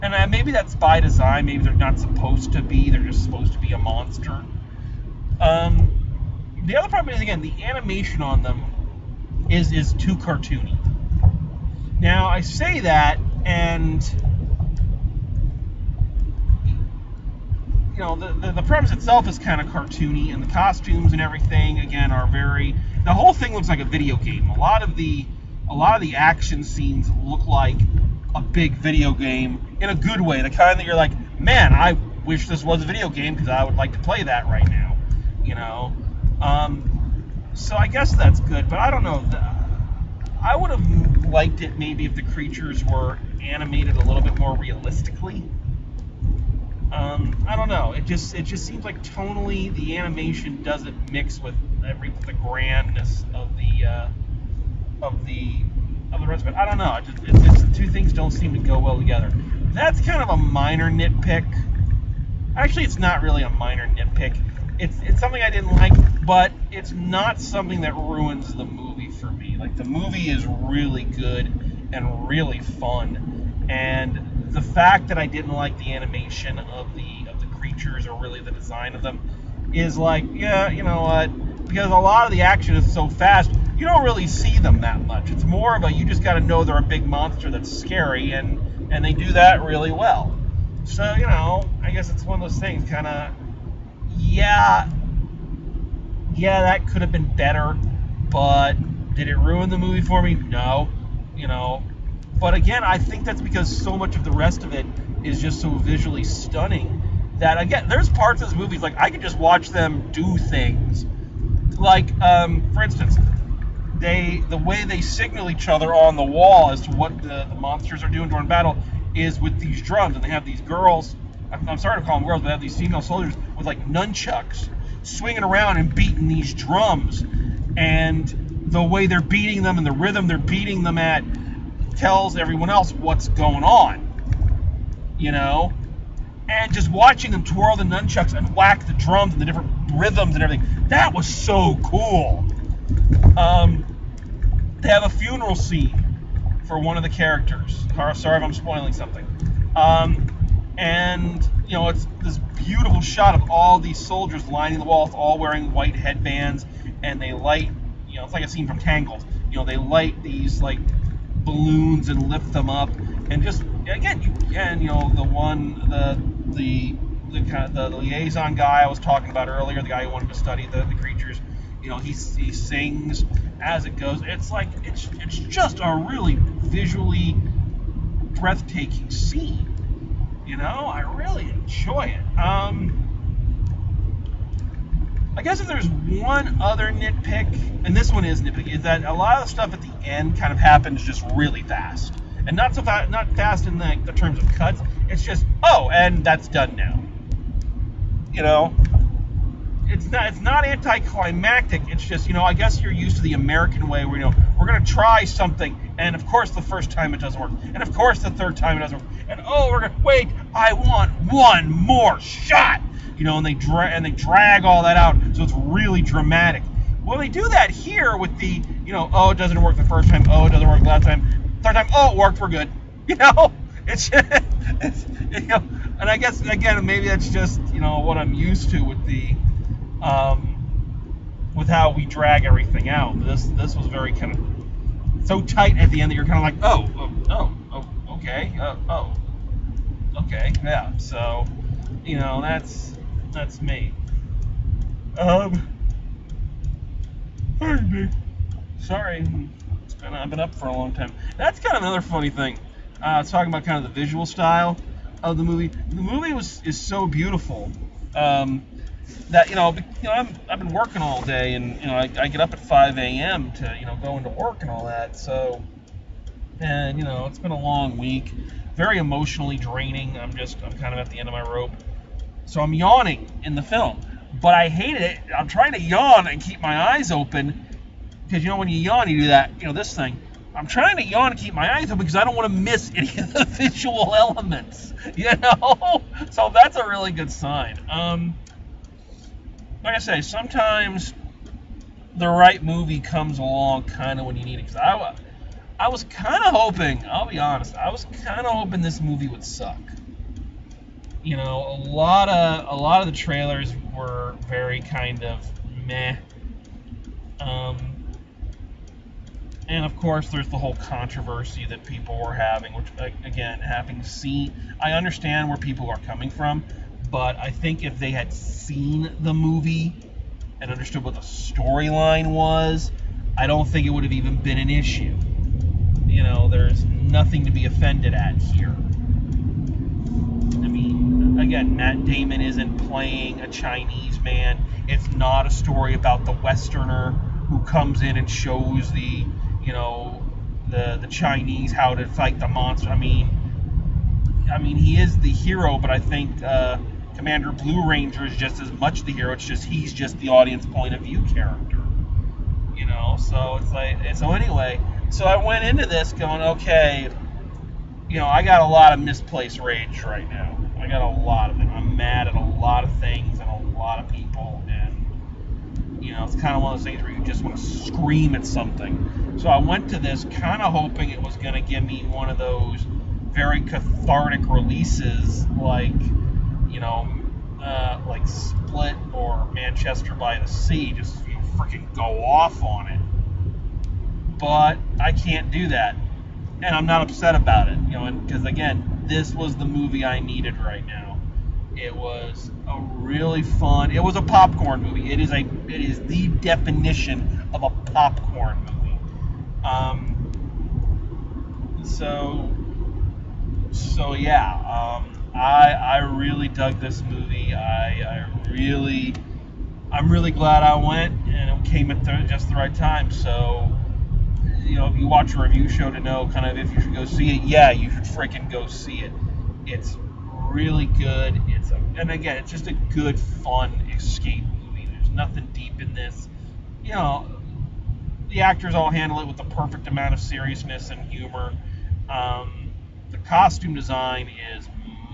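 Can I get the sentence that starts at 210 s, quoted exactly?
I want one more shot, you know, and they dra- and they drag all that out, so it's really dramatic.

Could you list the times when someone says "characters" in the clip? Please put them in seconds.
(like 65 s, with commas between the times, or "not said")
147 s, 351 s.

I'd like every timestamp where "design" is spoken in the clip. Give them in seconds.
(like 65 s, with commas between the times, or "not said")
0 s, 78 s, 433 s.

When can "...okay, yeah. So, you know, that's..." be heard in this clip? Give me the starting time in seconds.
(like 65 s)
240 s.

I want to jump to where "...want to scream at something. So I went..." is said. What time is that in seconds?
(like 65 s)
367 s.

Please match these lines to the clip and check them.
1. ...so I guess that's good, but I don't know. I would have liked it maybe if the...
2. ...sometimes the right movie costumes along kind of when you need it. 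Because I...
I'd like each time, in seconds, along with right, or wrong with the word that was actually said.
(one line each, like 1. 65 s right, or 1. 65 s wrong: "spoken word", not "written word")
1. 37 s right
2. 290 s wrong: "comes", not "costumes".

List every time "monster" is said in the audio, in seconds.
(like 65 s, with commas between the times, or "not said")
3 s, 87 s, 117 s, 342 s.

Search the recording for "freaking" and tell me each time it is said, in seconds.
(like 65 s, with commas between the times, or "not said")
381 s, 418 s.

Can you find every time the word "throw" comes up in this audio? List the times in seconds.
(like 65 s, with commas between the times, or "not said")
not said.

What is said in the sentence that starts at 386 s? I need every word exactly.
And I'm not upset about it, you know, because again, this was the movie I needed right now.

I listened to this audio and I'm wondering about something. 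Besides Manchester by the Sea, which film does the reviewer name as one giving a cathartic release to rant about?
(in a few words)
Split.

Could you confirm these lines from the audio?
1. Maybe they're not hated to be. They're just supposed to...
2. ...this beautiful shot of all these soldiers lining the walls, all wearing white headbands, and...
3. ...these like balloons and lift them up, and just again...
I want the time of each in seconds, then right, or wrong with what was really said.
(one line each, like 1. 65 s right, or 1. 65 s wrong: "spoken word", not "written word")
1. 1 s wrong: "supposed", not "hated"
2. 152 s right
3. 160 s right.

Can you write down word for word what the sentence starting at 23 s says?
The whole thing looks like a video game.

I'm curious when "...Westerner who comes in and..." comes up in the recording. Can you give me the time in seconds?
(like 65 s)
336 s.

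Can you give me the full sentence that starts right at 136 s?
And just watching them twirl the nunchucks and whack the drums and the different rhythms and everything, that was so cool.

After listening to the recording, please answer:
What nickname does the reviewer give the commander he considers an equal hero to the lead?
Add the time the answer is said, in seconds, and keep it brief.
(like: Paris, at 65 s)
Commander Blue Ranger, at 347 s.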